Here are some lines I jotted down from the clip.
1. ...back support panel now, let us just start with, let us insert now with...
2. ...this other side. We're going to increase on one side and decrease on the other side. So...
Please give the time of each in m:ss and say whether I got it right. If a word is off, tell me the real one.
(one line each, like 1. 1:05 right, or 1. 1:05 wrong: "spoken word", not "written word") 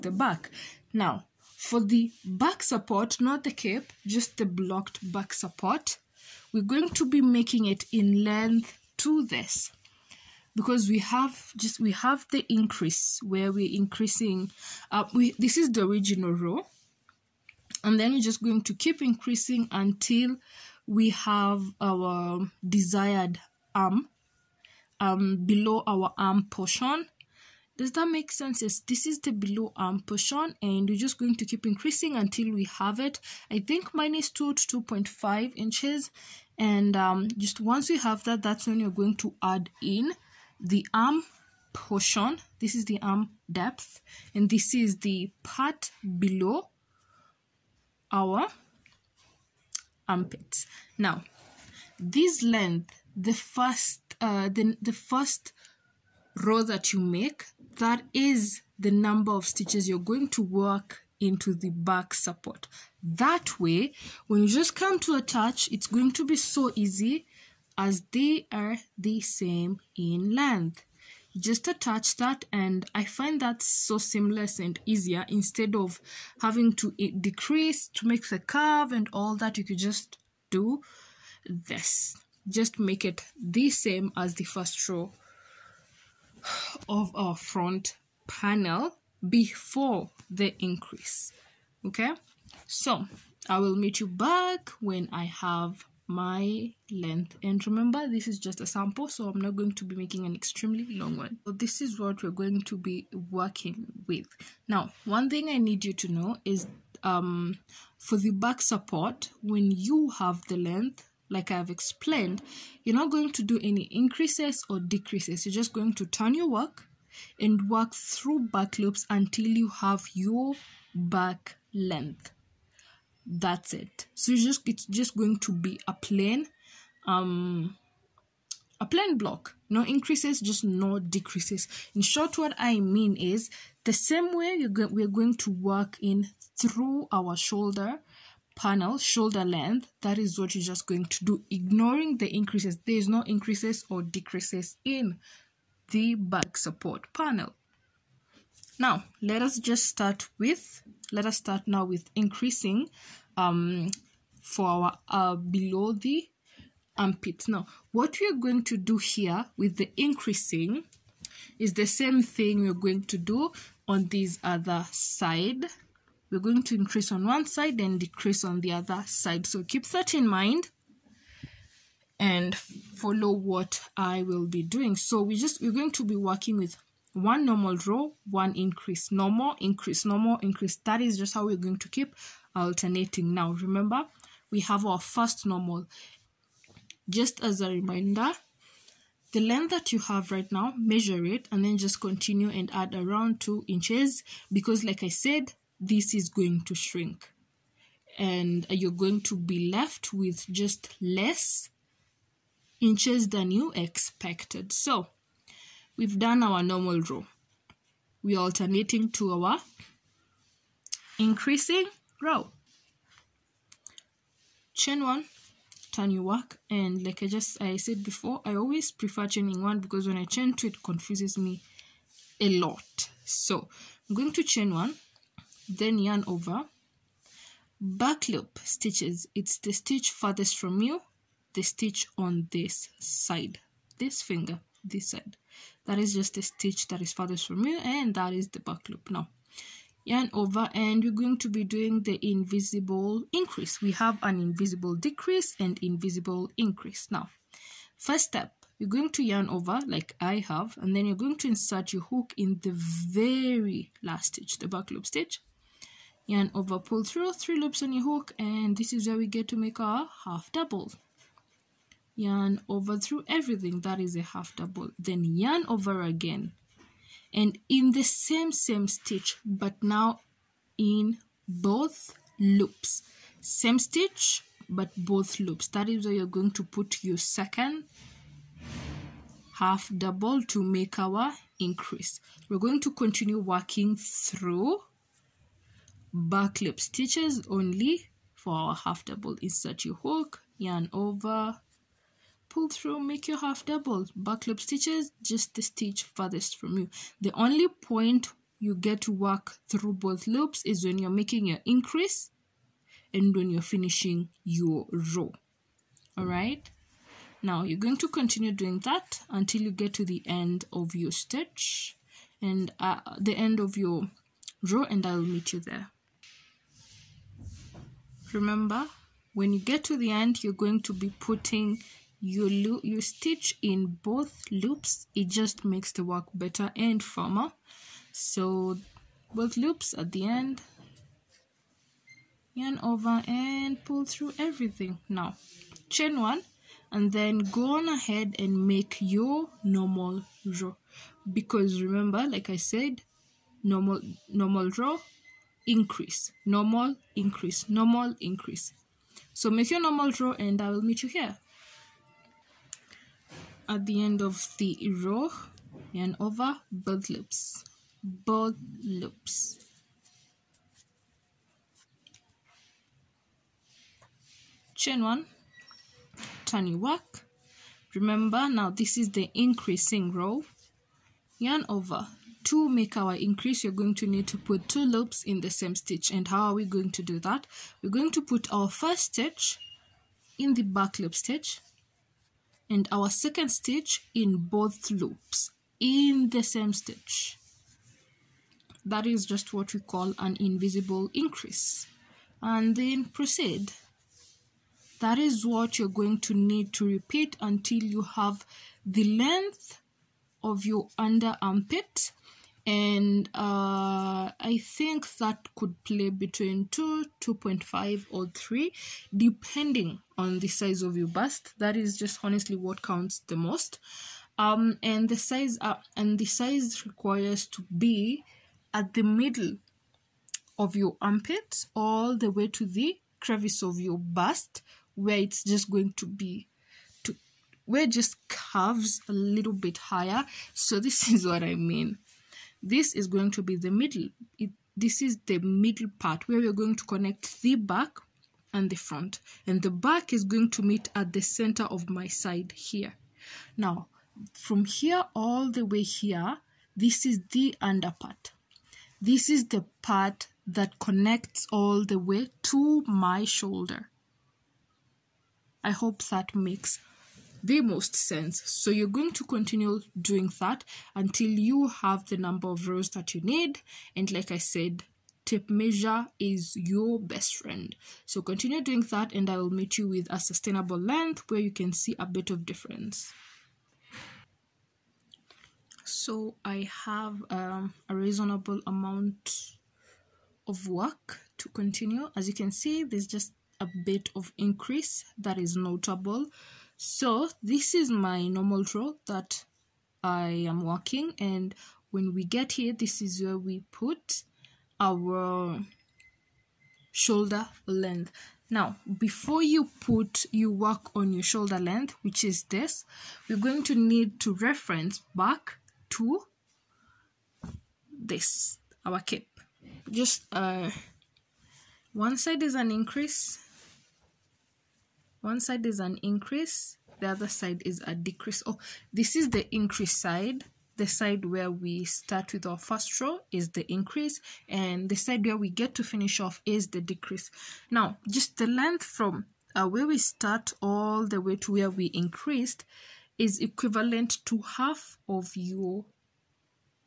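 1. 2:26 wrong: "start", not "insert"
2. 2:44 right.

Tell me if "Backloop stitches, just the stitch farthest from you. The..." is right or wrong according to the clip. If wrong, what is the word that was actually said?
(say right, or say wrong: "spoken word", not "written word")
right.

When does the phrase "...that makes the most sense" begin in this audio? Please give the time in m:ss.
7:36.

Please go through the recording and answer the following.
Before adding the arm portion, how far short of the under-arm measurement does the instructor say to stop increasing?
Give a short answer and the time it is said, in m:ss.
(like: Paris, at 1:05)
2 to 2.5 inches, at 0:33.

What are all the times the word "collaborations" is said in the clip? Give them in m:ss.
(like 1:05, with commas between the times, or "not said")
not said.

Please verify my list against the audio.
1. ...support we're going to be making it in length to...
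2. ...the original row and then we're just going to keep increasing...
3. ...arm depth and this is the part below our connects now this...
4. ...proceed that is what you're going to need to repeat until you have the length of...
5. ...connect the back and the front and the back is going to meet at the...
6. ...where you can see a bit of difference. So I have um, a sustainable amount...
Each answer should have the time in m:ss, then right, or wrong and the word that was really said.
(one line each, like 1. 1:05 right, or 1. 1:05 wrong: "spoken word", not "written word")
1. 0:05 right
2. 0:15 right
3. 0:43 wrong: "armpits", not "connects"
4. 6:33 right
5. 7:16 right
6. 7:51 wrong: "reasonable", not "sustainable".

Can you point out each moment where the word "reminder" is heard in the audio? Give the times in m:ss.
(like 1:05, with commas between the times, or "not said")
3:07.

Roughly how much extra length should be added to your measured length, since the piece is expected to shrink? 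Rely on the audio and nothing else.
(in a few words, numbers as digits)
2 inches.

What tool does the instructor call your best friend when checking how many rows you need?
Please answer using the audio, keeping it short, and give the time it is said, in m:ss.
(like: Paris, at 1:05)
tape measure, at 7:45.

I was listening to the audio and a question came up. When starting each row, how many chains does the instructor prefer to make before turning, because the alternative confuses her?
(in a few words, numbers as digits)
1.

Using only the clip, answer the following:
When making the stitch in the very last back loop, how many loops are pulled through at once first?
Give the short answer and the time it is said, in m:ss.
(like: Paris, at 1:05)
3, at 4:17.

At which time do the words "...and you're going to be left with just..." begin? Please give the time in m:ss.
3:18.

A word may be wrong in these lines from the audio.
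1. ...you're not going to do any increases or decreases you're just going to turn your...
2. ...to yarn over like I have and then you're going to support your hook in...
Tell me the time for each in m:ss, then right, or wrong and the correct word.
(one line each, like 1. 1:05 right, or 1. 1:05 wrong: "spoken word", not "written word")
1. 1:52 right
2. 4:09 wrong: "insert", not "support".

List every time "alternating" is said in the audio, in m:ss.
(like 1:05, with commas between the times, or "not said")
3:02, 3:28.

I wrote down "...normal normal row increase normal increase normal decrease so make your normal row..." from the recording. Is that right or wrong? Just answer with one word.
wrong.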